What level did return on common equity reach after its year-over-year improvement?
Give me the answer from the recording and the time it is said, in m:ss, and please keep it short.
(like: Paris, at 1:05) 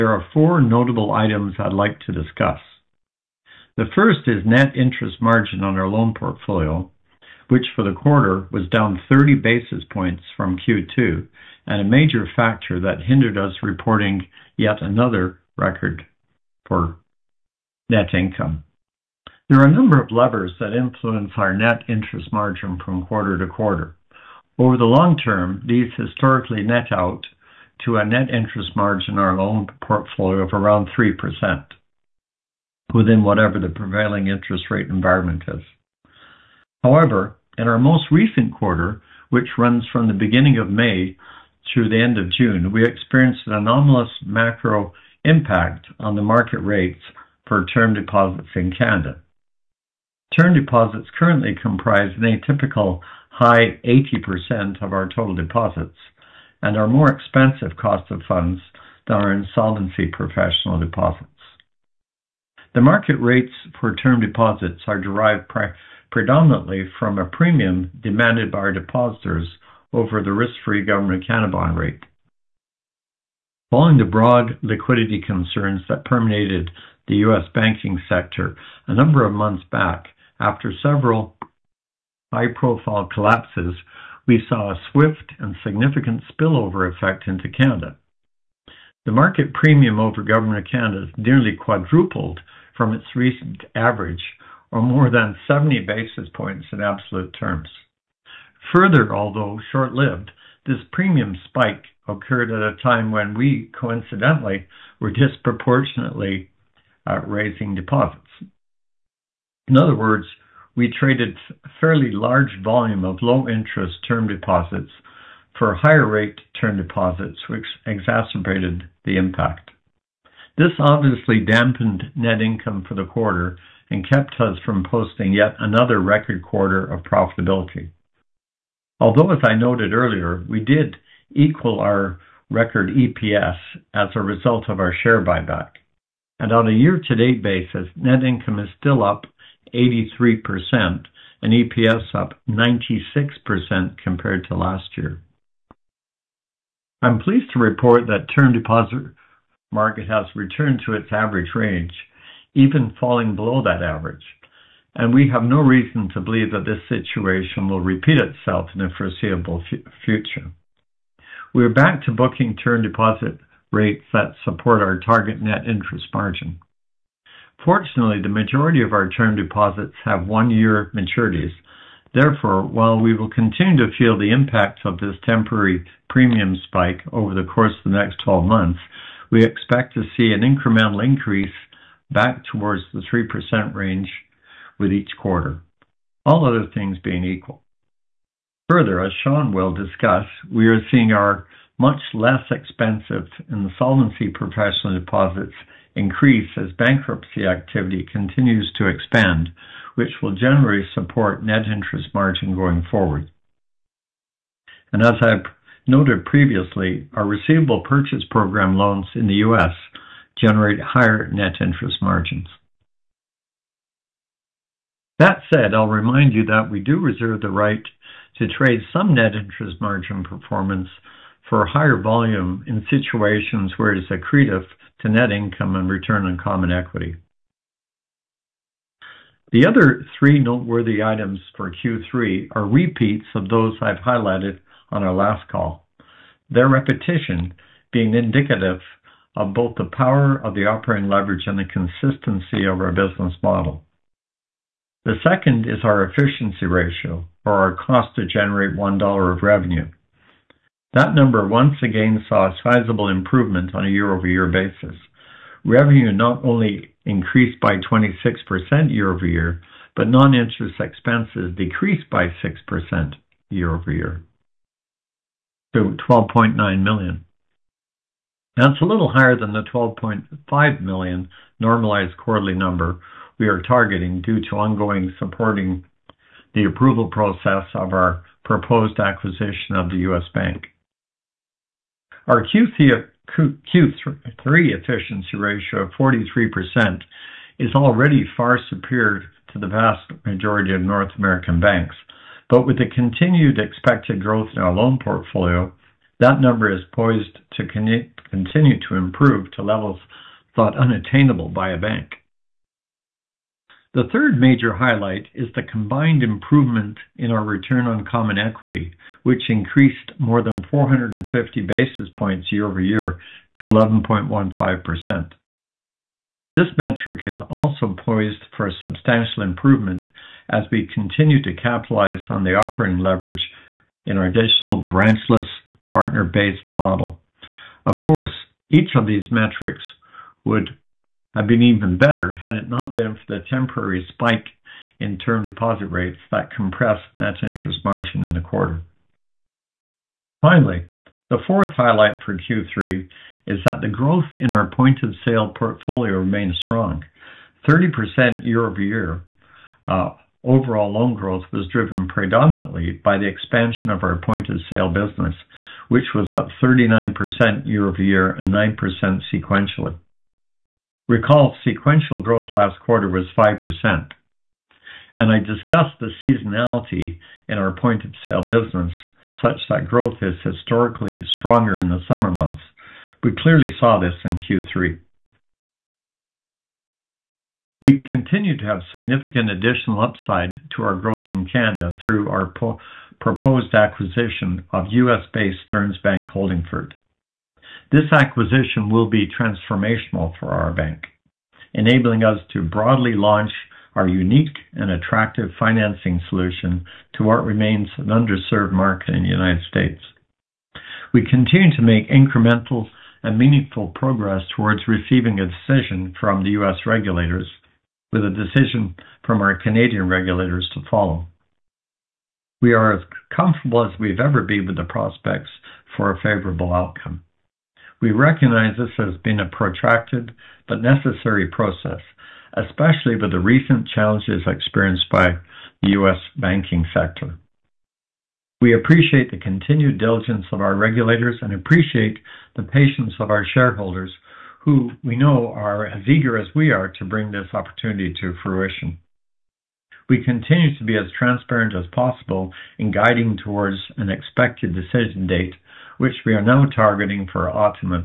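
11.15%, at 5:13.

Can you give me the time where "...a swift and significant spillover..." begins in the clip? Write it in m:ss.
1:24.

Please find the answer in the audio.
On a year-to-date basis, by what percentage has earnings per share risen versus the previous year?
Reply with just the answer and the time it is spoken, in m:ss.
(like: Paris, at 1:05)
96%, at 2:22.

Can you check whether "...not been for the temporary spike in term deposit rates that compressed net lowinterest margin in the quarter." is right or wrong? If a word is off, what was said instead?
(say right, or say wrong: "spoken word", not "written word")
wrong: "interest", not "lowinterest".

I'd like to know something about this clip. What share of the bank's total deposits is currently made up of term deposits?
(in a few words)
80%.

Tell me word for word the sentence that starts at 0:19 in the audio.
There are a number of levers that influence our net interest margin from quarter to quarter.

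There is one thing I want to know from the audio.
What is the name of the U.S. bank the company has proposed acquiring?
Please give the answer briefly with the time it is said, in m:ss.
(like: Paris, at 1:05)
Stearns Bank Holdingford, at 6:25.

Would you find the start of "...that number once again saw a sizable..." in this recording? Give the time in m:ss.
4:10.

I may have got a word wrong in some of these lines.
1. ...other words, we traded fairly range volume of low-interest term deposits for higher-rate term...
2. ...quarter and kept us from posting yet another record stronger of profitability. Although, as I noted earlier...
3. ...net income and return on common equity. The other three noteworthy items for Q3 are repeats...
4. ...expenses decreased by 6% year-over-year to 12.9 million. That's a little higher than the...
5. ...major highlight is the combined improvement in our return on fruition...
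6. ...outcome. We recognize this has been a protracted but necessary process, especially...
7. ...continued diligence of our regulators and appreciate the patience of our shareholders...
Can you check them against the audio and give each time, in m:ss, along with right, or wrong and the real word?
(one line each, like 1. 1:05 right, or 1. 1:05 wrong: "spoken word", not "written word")
1. 1:49 wrong: "large", not "range"
2. 2:03 wrong: "quarter", not "stronger"
3. 3:45 right
4. 4:20 right
5. 5:04 wrong: "common", not "fruition"
6. 6:56 right
7. 7:09 right.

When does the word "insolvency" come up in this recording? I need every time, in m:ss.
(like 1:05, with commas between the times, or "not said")
0:59, 3:13.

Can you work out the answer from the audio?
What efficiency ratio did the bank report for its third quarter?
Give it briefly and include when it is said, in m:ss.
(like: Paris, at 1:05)
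43%, at 4:45.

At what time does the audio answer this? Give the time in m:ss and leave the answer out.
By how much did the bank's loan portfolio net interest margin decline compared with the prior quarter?
0:09.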